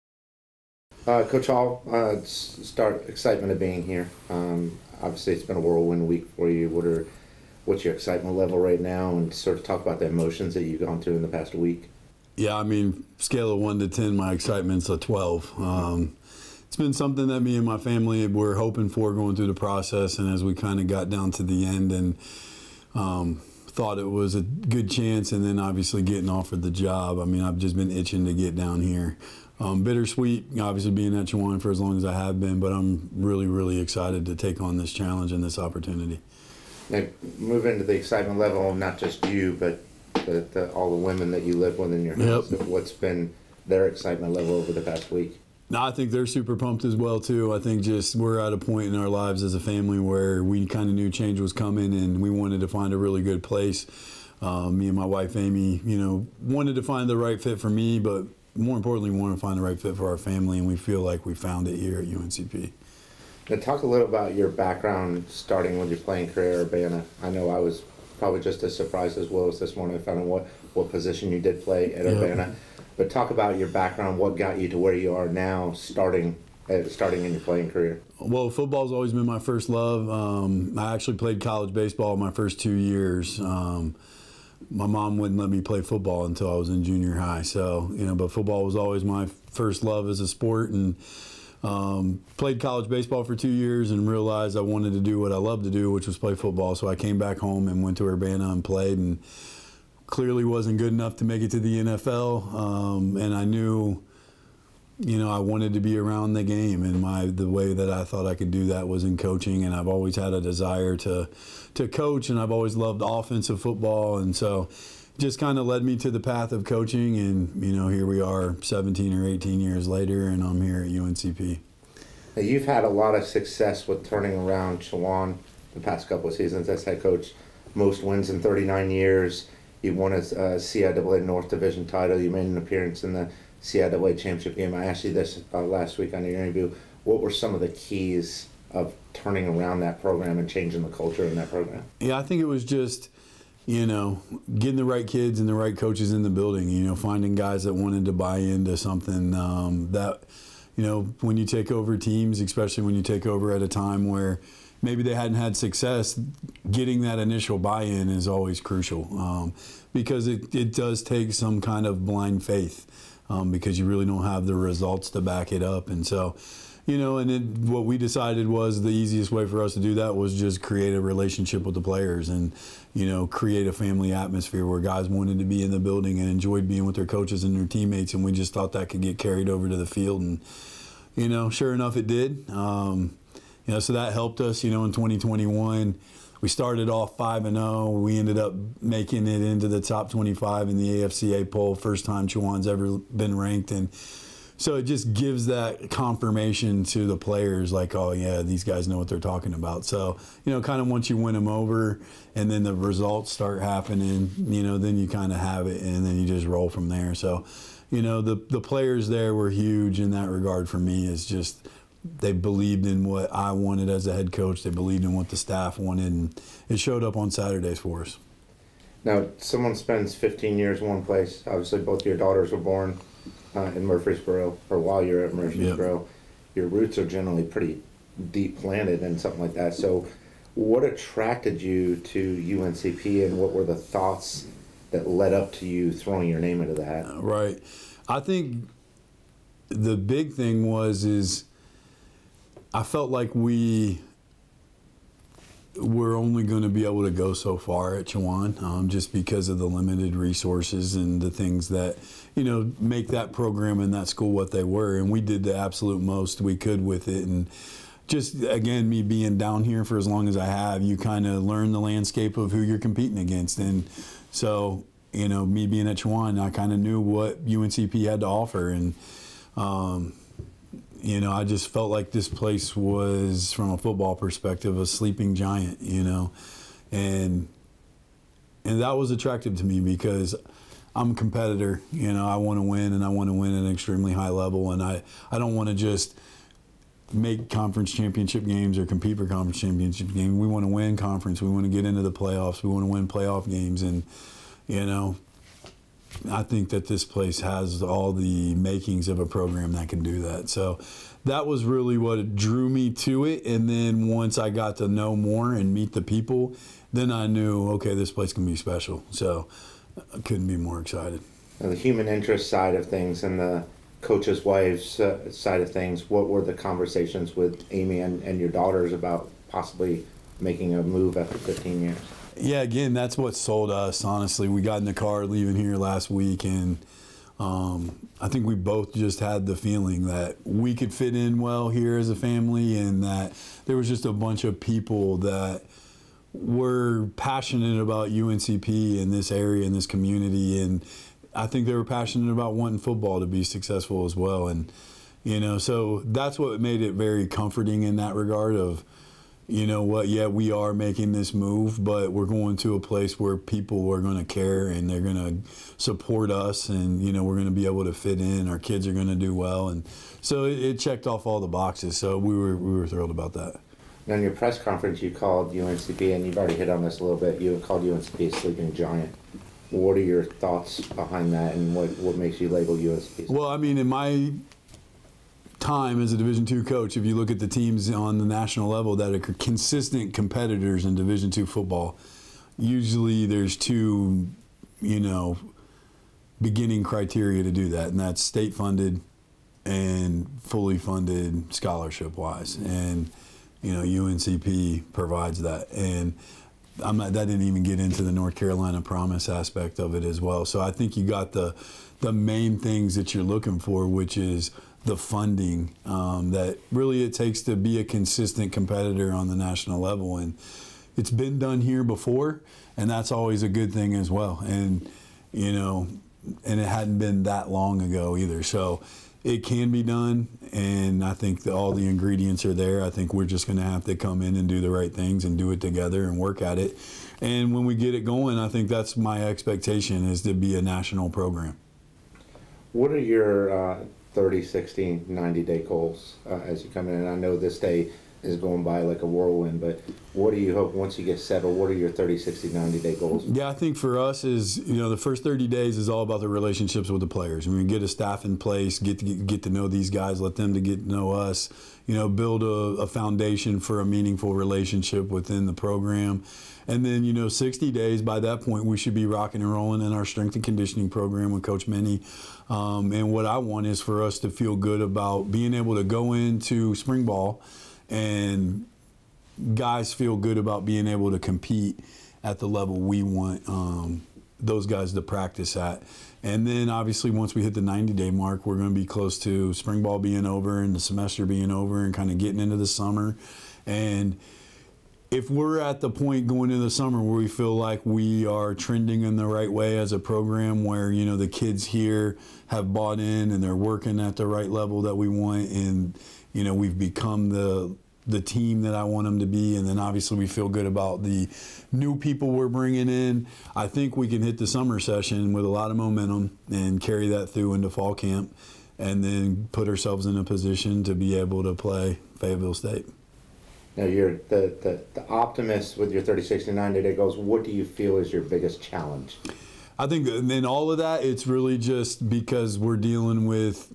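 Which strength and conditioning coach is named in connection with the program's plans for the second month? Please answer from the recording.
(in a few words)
Coach Minnie.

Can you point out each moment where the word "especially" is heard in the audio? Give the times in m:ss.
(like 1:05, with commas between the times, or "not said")
2:32.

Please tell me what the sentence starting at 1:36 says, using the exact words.
So I came back home and went to Urbana and played and clearly wasn't good enough to make it to the NFL.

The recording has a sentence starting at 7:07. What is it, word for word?
And when we get it going, I think that's my expectation is to be a national program.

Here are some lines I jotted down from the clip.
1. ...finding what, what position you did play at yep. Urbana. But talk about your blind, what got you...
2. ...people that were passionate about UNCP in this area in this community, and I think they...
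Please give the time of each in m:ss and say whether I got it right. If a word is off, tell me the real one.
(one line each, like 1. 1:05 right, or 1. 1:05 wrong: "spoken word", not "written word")
1. 1:09 wrong: "background", not "blind"
2. 5:34 right.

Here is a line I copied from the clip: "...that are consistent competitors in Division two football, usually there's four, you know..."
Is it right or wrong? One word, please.
wrong.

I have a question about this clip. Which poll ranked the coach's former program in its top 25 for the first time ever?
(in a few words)
AFCA poll.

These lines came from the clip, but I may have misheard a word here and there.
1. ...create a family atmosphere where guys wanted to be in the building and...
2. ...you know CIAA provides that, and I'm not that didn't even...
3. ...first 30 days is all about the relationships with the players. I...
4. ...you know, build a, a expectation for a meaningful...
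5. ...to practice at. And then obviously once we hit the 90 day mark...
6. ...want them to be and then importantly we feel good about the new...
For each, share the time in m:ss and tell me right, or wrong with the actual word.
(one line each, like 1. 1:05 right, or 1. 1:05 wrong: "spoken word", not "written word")
1. 2:53 right
2. 6:33 wrong: "UNCP", not "CIAA"
3. 7:24 right
4. 7:31 wrong: "foundation", not "expectation"
5. 7:54 right
6. 8:18 wrong: "obviously", not "importantly".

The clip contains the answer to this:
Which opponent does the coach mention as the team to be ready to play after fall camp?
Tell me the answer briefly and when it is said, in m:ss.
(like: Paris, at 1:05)
Fayetteville State, at 8:32.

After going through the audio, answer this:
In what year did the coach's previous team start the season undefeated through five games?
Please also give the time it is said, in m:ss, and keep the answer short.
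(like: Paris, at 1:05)
2021, at 3:04.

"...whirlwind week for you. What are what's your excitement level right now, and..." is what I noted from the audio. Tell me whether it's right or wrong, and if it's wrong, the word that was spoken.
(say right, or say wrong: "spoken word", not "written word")
right.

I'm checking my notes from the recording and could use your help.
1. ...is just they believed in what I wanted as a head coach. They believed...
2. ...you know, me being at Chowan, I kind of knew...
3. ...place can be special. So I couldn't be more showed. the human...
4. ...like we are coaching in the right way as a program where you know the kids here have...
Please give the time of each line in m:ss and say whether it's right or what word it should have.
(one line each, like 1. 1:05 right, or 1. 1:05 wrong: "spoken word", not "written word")
1. 3:31 right
2. 4:25 right
3. 5:08 wrong: "excited", not "showed"
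4. 8:07 wrong: "trending", not "coaching".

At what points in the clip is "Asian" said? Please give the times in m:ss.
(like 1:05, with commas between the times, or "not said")
not said.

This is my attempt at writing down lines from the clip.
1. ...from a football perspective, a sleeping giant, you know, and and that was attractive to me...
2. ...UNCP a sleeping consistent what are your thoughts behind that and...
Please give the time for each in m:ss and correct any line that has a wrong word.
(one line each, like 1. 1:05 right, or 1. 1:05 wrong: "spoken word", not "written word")
1. 4:33 right
2. 6:07 wrong: "giant", not "consistent".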